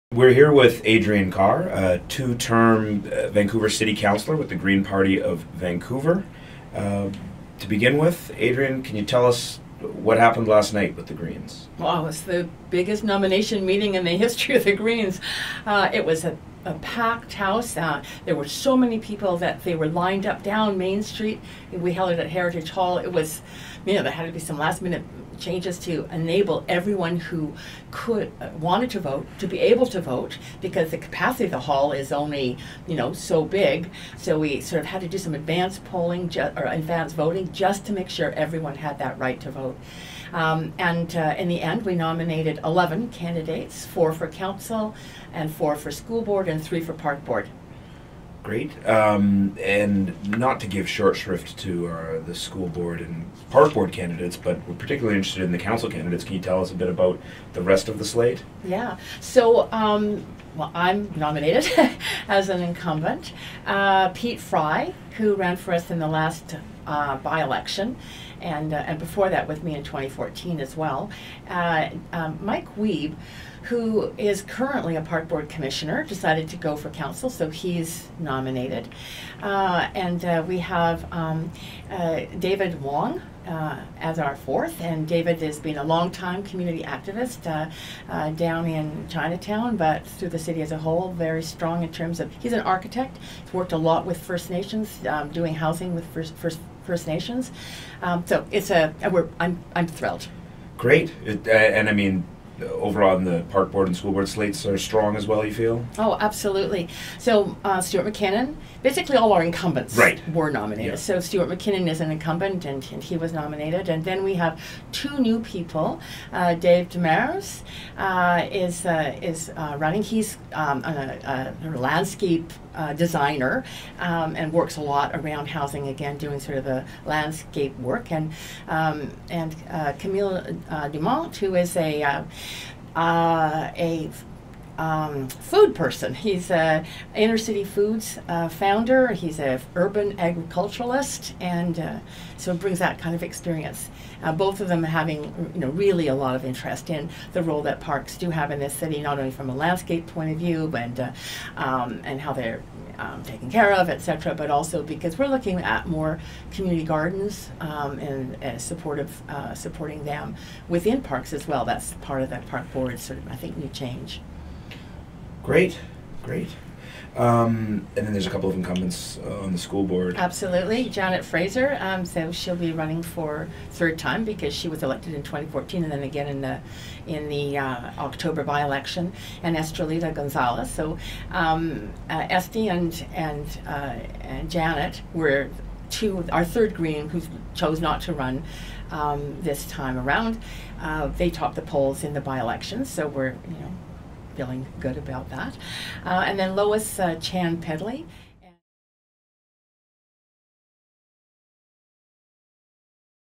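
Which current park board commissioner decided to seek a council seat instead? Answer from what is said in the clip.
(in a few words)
Mike Wiebe.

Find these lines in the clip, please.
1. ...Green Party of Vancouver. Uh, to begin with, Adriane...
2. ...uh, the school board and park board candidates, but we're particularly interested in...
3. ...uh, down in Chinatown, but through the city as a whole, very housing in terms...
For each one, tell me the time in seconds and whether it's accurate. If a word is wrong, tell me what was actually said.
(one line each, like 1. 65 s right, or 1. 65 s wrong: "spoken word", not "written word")
1. 4 s right
2. 51 s right
3. 88 s wrong: "strong", not "housing".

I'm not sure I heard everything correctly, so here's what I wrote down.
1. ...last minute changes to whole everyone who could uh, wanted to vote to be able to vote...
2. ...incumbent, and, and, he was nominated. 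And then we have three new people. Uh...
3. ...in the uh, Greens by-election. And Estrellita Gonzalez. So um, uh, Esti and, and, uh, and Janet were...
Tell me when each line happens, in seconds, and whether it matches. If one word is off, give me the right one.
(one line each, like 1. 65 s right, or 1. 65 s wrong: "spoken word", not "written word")
1. 24 s wrong: "enable", not "whole"
2. 112 s wrong: "two", not "three"
3. 177 s wrong: "October", not "Greens".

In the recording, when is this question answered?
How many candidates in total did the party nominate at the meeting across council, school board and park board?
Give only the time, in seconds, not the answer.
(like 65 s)
42 s.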